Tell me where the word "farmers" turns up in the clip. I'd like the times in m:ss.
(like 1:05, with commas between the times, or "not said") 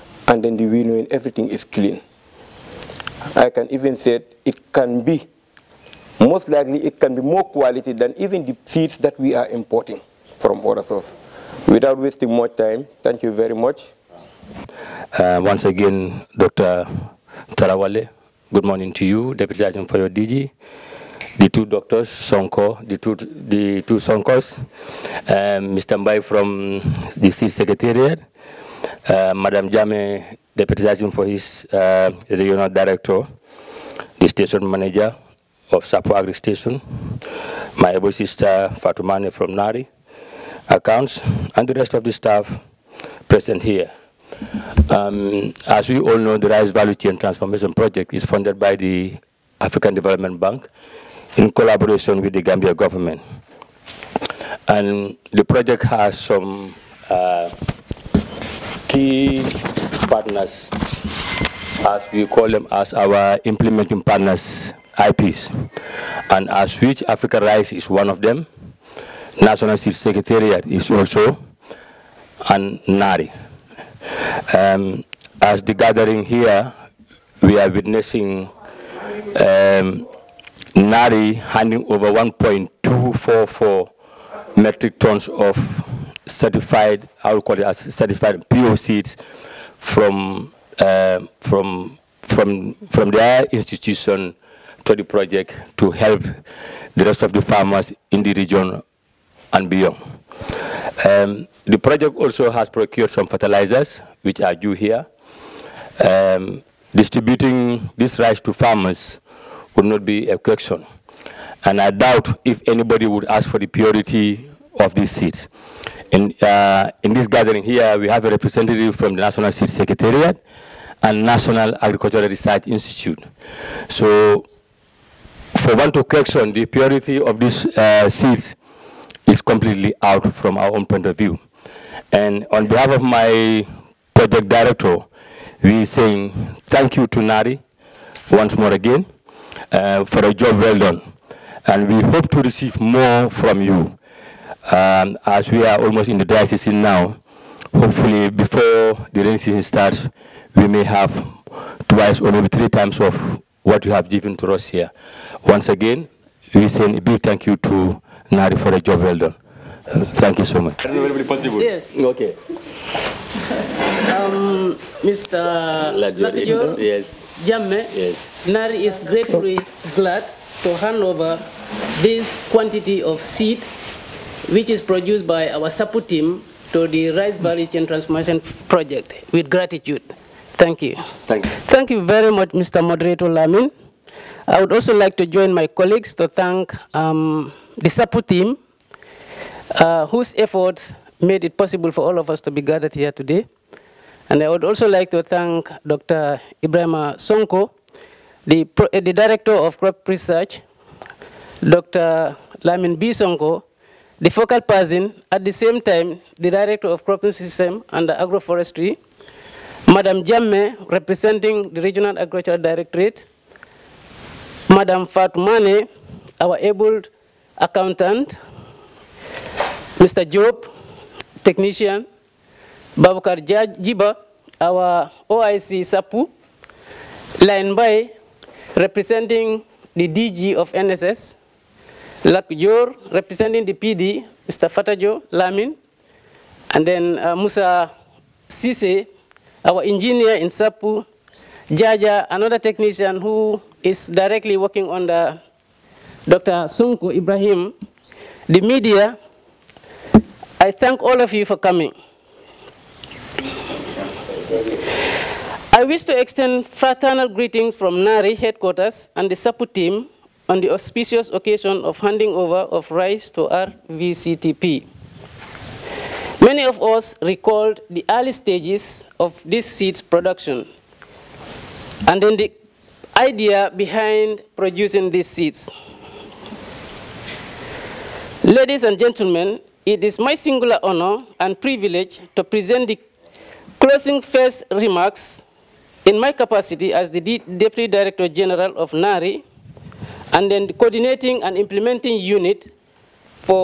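1:37, 1:48.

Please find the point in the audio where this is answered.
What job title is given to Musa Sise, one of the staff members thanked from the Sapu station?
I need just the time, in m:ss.
3:59.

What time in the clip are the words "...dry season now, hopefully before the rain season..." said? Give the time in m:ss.
2:26.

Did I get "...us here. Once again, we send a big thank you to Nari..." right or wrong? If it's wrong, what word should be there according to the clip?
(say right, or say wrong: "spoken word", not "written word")
right.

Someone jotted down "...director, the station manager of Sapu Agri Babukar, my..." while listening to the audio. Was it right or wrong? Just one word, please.
wrong.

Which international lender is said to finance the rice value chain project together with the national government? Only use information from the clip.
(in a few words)
African Development Bank.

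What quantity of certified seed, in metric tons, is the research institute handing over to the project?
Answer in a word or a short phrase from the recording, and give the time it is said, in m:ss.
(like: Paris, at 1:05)
1.244 metric tons, at 1:22.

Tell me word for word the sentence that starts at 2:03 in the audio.
So, for one to question, the purity of these uh, seeds is completely out from our own point of view.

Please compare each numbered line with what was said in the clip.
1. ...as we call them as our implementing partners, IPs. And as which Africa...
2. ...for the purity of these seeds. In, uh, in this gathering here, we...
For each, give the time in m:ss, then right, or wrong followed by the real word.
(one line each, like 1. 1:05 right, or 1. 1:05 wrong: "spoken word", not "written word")
1. 1:01 right
2. 1:53 right.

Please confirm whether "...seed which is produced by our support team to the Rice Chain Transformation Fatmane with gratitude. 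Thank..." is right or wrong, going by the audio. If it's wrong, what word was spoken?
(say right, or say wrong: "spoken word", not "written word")
wrong: "Project", not "Fatmane".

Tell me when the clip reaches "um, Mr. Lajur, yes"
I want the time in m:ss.
2:44.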